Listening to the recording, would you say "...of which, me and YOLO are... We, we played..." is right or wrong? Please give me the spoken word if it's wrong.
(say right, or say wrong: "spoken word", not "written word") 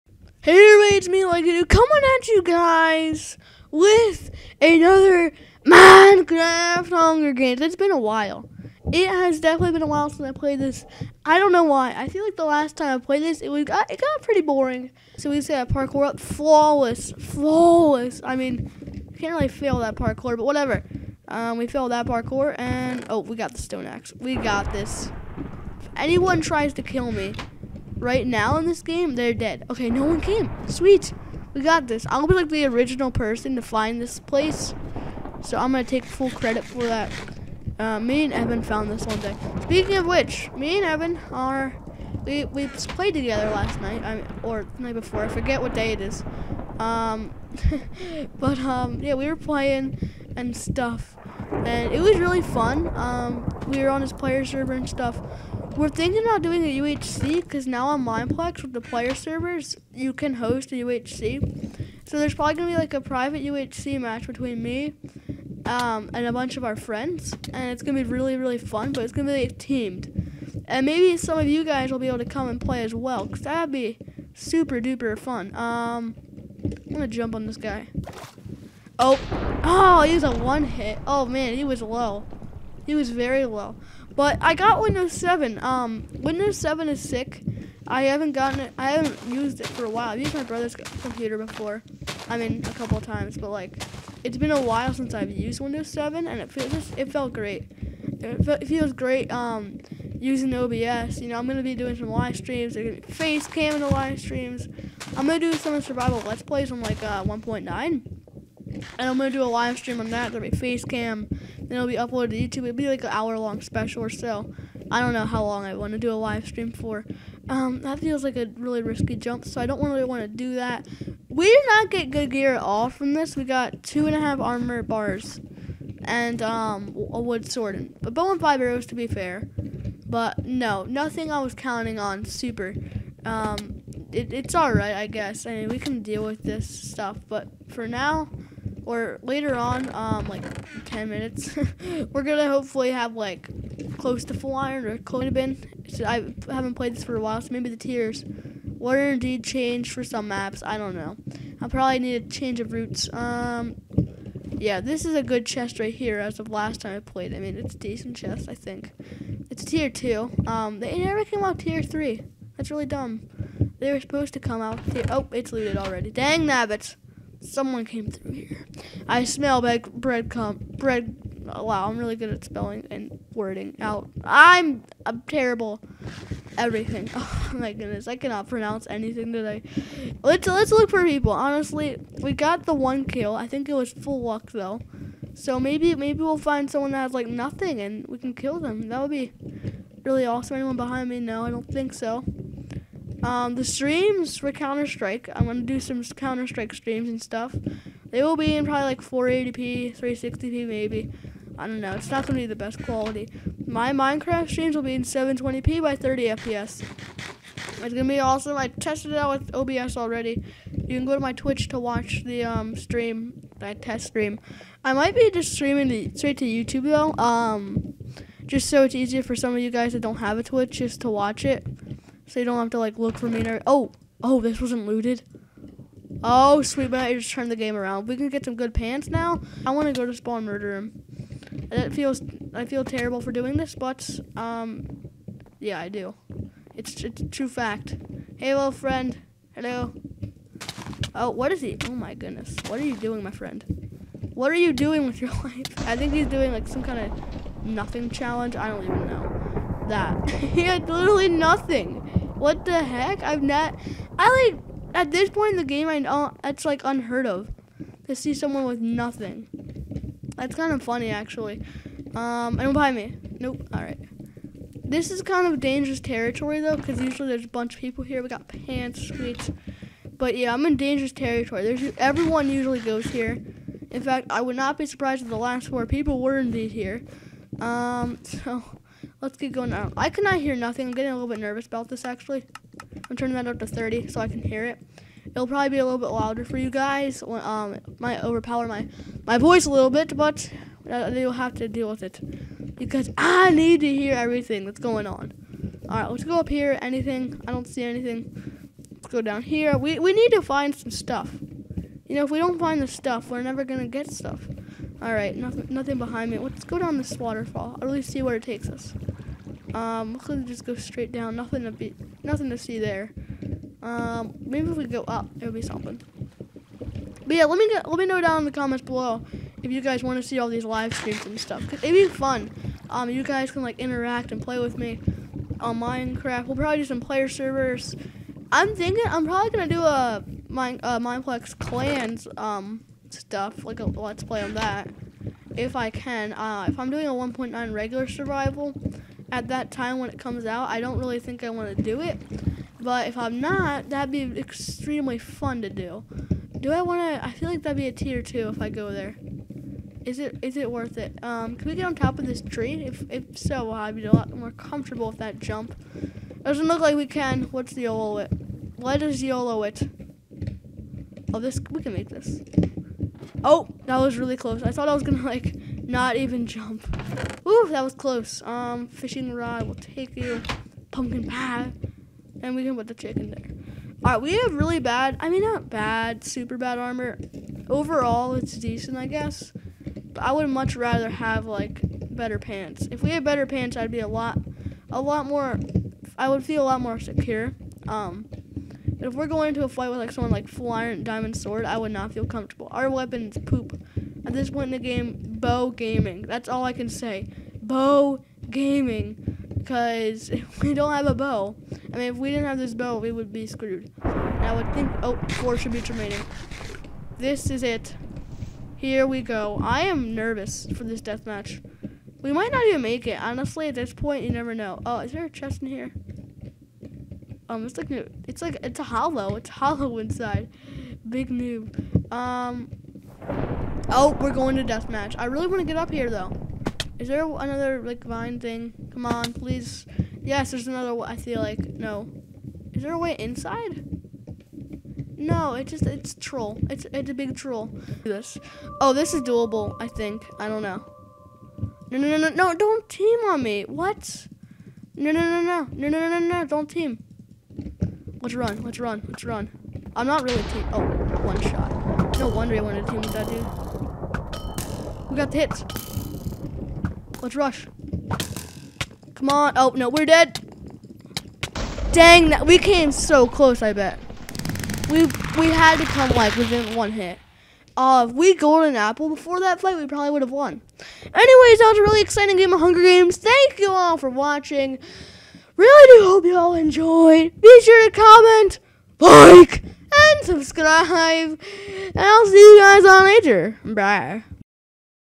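wrong: "Evan", not "YOLO".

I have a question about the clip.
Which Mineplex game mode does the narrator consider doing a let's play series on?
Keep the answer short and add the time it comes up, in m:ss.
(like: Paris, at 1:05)
clans, at 5:30.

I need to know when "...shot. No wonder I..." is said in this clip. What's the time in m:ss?
7:31.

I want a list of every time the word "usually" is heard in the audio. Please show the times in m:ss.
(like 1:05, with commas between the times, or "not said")
4:26, 4:32.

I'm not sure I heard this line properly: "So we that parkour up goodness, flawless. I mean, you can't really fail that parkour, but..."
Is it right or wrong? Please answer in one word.
wrong.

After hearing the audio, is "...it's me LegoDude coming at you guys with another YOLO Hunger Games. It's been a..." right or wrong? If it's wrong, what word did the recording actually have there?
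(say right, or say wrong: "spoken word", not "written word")
wrong: "Minecraft", not "YOLO".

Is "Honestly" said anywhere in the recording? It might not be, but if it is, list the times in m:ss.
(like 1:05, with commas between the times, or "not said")
3:01, 6:53.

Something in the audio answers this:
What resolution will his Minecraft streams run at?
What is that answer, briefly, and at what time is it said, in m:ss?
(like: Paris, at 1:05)
720p, at 3:25.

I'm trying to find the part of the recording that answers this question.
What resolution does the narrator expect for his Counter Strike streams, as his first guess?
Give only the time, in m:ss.
3:19.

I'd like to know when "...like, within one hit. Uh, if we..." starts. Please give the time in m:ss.
7:46.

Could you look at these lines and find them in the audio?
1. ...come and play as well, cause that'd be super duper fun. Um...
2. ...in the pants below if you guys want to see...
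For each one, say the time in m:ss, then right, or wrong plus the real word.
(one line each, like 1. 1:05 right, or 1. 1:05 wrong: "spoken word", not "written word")
1. 1:12 right
2. 5:18 wrong: "comments", not "pants".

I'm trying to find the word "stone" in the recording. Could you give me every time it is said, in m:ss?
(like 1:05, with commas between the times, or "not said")
0:23.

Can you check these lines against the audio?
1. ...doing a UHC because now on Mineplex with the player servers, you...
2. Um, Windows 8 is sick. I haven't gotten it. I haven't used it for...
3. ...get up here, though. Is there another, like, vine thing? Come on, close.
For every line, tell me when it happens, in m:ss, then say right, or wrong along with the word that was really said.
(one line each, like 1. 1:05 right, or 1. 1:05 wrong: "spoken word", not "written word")
1. 0:56 right
2. 1:25 wrong: "7", not "8"
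3. 7:05 wrong: "please", not "close".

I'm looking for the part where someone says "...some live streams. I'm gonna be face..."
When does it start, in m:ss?
1:41.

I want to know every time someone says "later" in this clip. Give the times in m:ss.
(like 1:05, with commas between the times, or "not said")
2:19, 8:03.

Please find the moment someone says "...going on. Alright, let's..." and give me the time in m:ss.
4:54.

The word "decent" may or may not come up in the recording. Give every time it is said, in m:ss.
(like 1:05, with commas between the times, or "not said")
2:37, 6:18.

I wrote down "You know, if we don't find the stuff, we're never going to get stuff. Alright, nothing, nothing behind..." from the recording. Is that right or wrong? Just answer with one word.
right.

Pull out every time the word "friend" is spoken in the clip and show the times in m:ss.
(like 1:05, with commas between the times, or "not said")
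1:06, 3:58, 4:03.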